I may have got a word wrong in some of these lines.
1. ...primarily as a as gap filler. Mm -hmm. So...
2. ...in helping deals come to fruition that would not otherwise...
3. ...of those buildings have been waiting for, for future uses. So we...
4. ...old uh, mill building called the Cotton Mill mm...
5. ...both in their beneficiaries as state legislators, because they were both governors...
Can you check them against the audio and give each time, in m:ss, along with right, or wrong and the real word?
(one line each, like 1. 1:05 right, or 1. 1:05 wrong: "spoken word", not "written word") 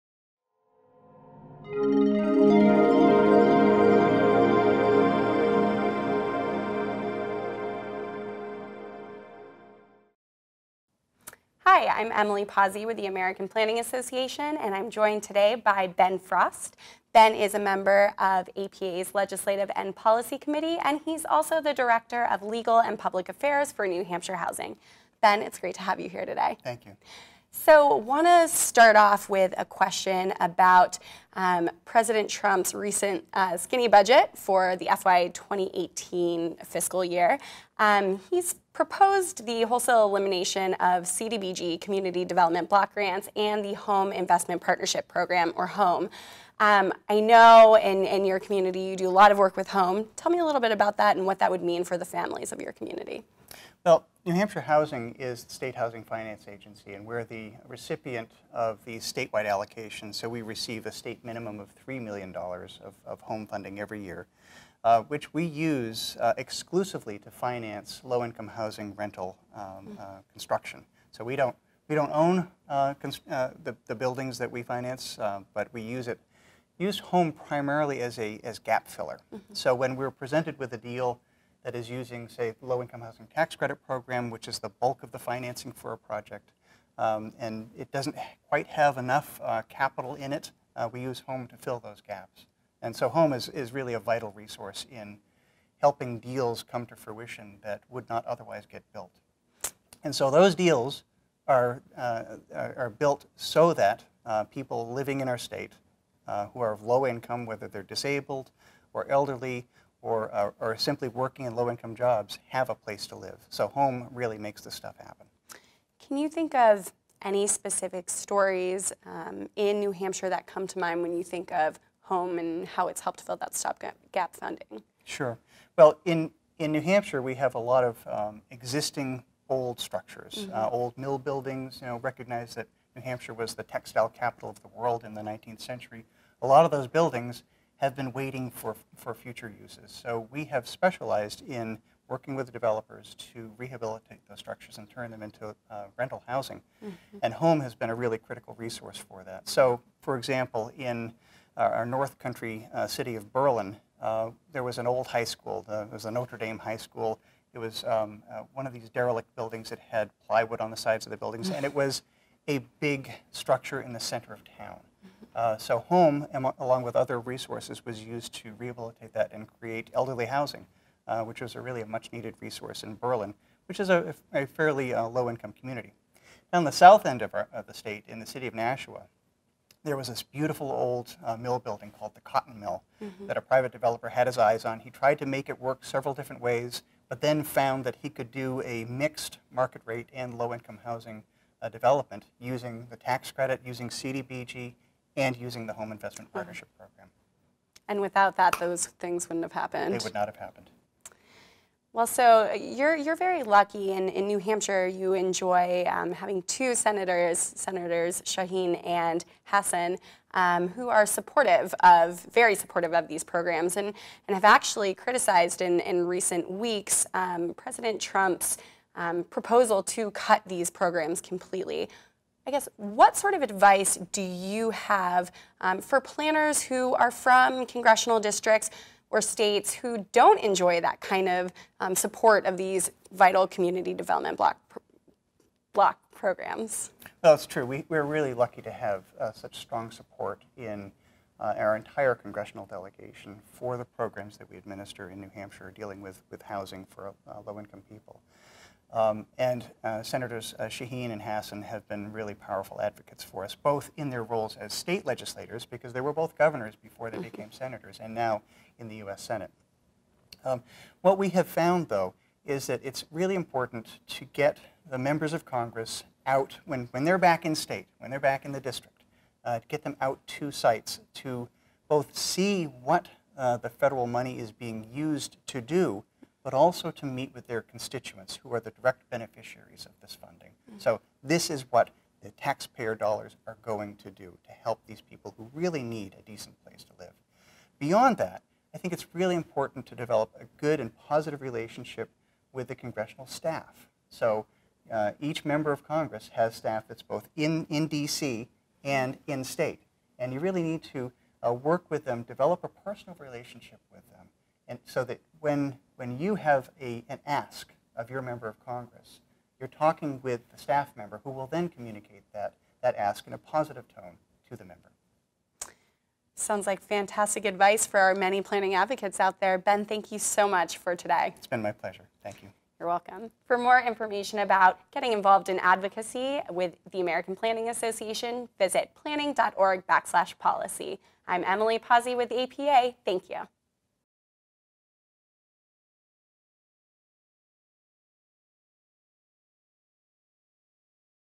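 1. 1:17 right
2. 1:34 right
3. 2:16 right
4. 3:00 right
5. 4:13 wrong: "roles", not "beneficiaries".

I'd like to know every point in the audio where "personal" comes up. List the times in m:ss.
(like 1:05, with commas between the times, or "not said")
5:02.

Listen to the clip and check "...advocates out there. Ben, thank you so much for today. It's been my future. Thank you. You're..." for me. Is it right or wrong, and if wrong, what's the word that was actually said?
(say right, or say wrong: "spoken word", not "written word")
wrong: "pleasure", not "future".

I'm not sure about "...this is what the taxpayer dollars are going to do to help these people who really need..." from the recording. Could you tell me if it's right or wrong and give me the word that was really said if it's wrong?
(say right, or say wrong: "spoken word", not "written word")
right.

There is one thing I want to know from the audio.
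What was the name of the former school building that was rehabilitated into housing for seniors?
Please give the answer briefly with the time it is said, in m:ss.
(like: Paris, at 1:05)
Notre Dame High School, at 2:36.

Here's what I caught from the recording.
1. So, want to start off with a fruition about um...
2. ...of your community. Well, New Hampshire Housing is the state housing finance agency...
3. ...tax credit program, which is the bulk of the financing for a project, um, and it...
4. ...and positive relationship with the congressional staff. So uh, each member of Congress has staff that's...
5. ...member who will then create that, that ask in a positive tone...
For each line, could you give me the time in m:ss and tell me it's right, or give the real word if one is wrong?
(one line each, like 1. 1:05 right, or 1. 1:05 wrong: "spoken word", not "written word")
1. 0:27 wrong: "question", not "fruition"
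2. 0:52 right
3. 1:23 right
4. 4:50 right
5. 5:10 wrong: "communicate", not "create".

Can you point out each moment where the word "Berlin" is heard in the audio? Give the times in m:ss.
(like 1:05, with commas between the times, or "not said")
2:33, 2:52.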